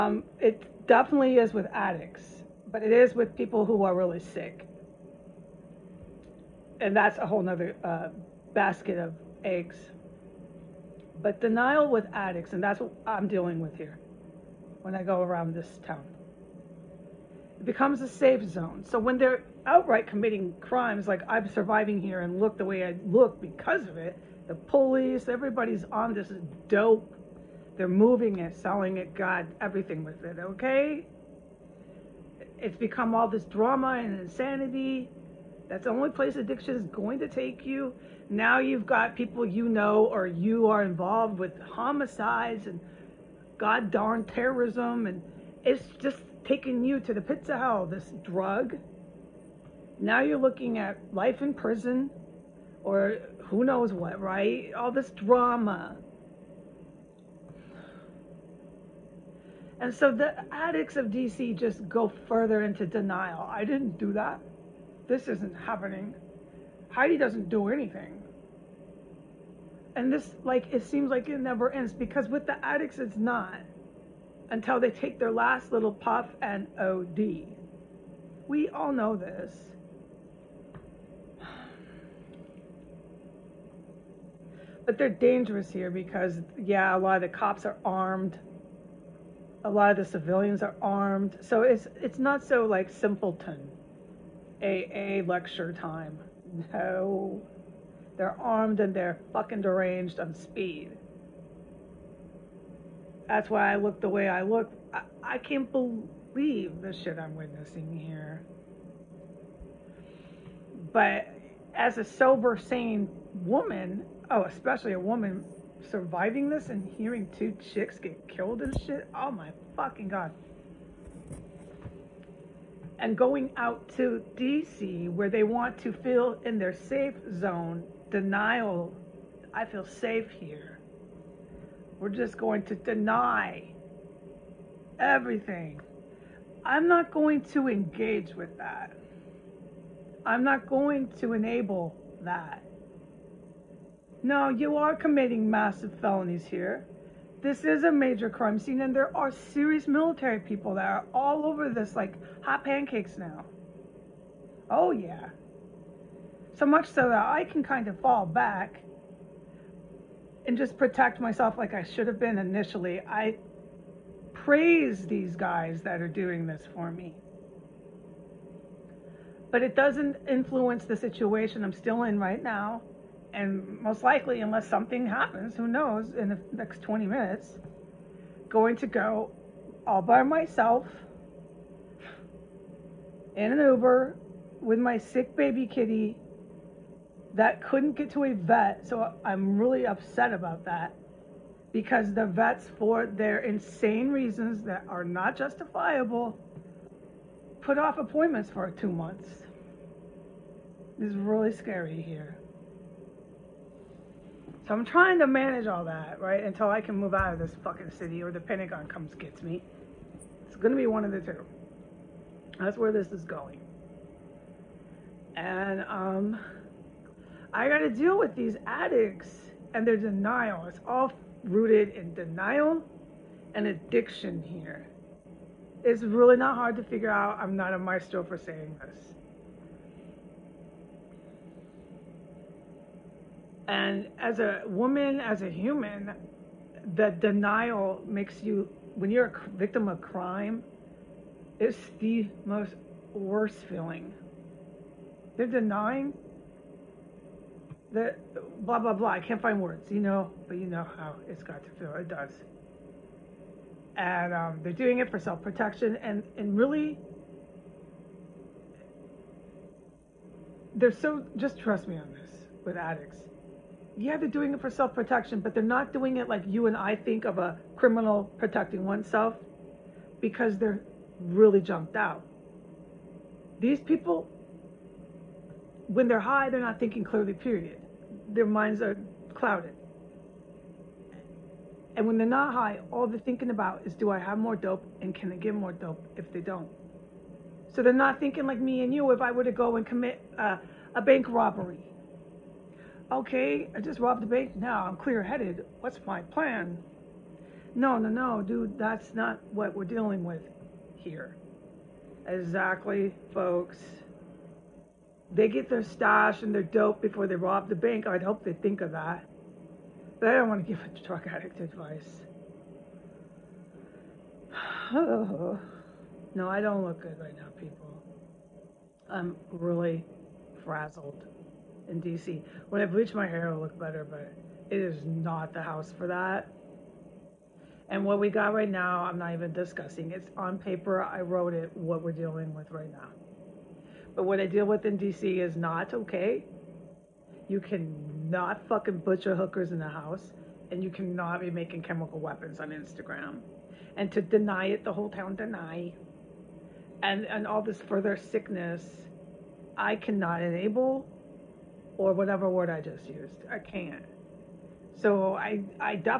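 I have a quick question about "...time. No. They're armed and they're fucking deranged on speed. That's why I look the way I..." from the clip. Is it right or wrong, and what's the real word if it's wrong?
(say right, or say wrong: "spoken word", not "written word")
right.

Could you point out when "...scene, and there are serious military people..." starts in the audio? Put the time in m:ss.
2:28.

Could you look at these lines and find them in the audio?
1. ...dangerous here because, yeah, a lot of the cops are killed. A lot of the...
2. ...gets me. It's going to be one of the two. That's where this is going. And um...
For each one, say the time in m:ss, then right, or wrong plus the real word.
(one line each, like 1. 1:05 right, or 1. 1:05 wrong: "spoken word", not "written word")
1. 1:25 wrong: "armed", not "killed"
2. 3:29 right.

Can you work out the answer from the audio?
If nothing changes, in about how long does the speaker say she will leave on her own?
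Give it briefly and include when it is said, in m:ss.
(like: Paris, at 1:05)
20 minutes, at 2:56.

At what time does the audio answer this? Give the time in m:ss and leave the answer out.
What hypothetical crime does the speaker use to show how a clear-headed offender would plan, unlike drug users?
4:50.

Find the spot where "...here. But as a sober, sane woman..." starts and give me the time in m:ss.
1:47.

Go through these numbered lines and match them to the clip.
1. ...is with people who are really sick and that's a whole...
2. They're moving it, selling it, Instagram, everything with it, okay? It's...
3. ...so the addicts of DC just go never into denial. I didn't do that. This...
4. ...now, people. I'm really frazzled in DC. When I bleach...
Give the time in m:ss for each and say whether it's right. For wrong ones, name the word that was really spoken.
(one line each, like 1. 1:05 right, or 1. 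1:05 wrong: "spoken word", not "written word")
1. 0:02 right
2. 0:27 wrong: "God", not "Instagram"
3. 0:59 wrong: "further", not "never"
4. 5:17 right.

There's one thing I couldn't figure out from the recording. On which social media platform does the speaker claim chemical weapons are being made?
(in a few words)
Instagram.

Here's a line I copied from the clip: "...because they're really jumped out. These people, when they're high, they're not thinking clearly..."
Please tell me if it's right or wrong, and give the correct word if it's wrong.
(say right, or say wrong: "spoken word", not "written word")
right.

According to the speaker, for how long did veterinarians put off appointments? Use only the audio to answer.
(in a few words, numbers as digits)
Two months.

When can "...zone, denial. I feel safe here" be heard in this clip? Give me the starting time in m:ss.
2:07.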